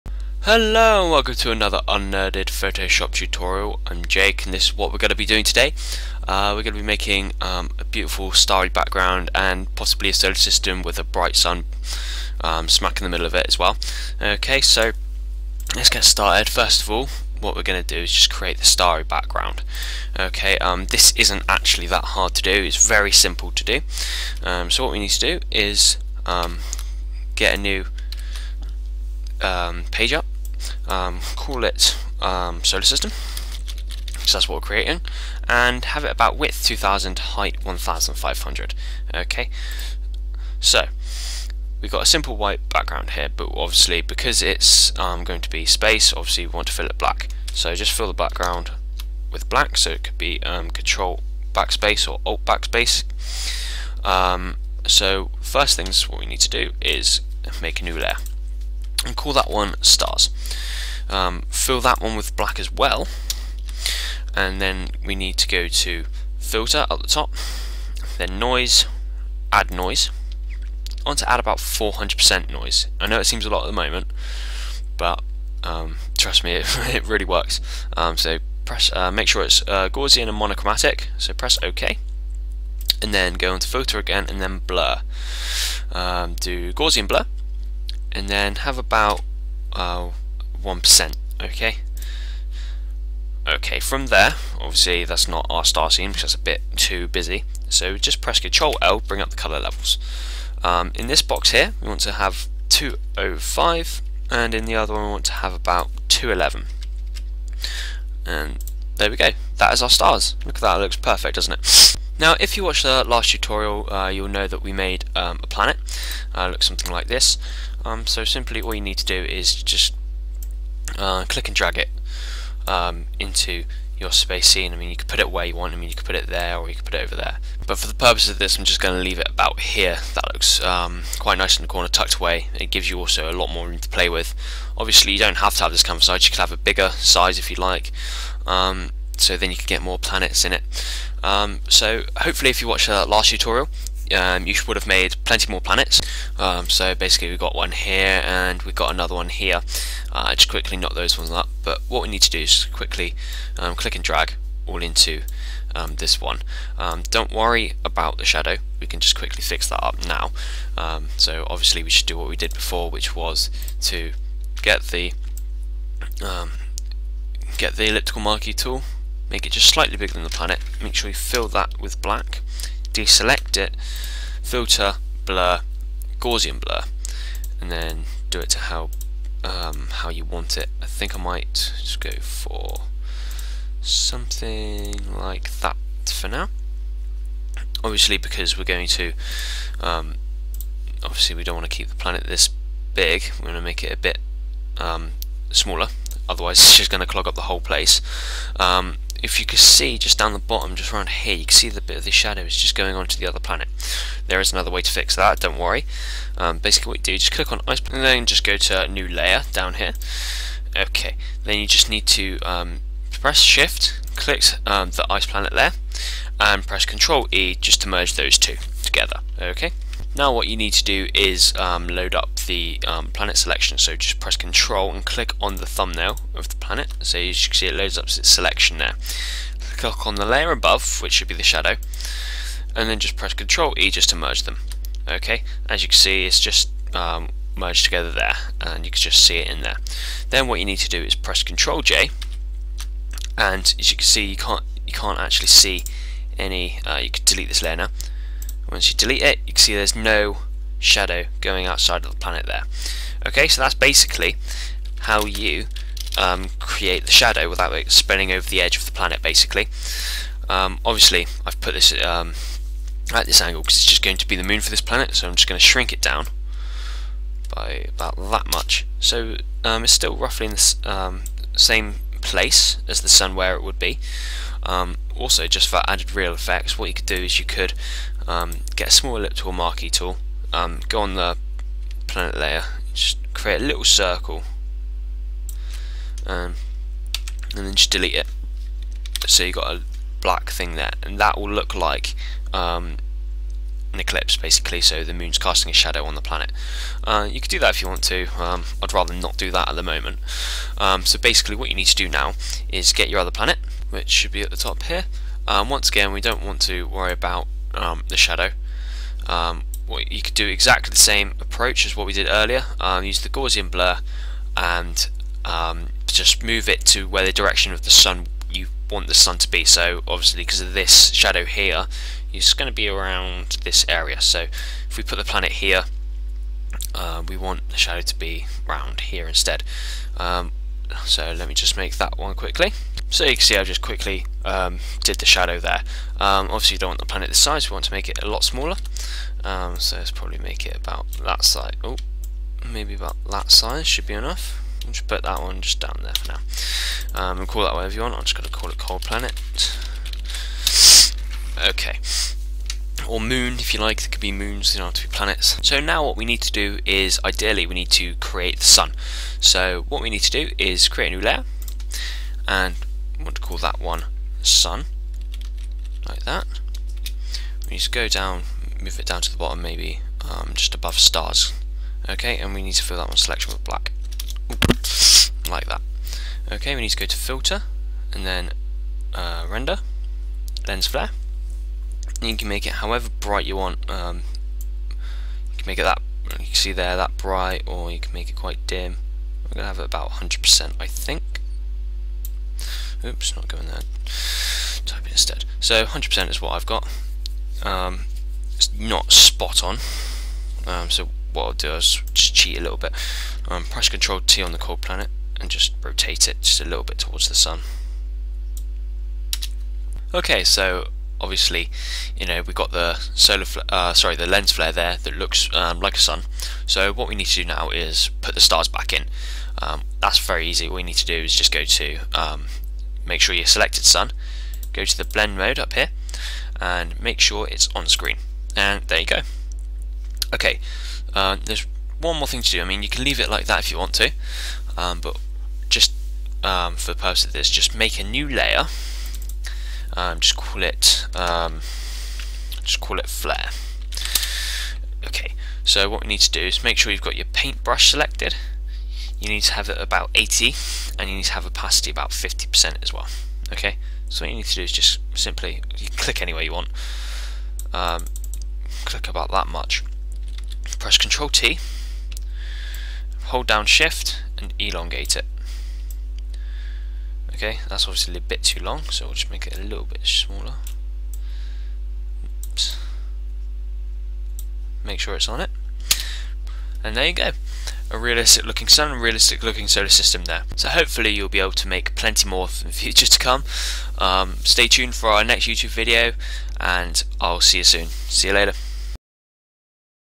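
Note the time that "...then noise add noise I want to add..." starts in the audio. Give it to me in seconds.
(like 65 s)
68 s.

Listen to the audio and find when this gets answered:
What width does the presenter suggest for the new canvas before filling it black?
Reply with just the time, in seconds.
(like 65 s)
36 s.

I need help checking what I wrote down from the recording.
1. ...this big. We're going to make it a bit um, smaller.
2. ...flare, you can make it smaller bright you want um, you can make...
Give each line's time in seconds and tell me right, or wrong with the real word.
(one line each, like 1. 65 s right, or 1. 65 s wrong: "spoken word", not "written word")
1. 192 s right
2. 380 s wrong: "however", not "smaller".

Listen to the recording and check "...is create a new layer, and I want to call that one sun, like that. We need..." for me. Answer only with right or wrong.
right.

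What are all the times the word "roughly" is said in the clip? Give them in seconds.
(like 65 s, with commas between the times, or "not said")
270 s.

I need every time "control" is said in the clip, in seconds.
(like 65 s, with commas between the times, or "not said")
50 s, 216 s, 224 s, 233 s, 241 s, 403 s, 460 s.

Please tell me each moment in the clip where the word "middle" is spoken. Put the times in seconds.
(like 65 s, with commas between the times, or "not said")
13 s.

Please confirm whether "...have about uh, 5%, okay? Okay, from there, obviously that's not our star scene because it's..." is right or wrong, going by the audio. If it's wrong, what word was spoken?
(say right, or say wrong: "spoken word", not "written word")
wrong: "1", not "5".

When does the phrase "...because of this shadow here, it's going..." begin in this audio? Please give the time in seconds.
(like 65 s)
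320 s.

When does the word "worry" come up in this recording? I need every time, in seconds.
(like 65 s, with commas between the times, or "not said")
157 s, 205 s, 306 s.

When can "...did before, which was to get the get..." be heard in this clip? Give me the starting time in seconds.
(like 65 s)
162 s.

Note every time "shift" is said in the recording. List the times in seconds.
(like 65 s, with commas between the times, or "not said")
213 s, 463 s.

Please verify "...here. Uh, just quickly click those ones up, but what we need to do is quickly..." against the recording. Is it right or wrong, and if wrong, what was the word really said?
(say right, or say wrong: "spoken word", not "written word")
wrong: "knock", not "click".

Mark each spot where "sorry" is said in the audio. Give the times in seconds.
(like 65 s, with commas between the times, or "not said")
413 s.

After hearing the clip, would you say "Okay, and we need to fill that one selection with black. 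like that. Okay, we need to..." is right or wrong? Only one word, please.
right.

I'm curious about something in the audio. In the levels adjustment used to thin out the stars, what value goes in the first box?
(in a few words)
205.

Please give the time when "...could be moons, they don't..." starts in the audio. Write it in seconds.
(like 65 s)
354 s.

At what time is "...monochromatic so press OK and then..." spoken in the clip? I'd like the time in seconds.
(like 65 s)
80 s.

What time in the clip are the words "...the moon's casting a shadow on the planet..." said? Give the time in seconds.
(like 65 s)
295 s.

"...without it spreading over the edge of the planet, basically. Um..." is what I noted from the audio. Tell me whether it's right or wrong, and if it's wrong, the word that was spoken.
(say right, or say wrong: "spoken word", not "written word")
right.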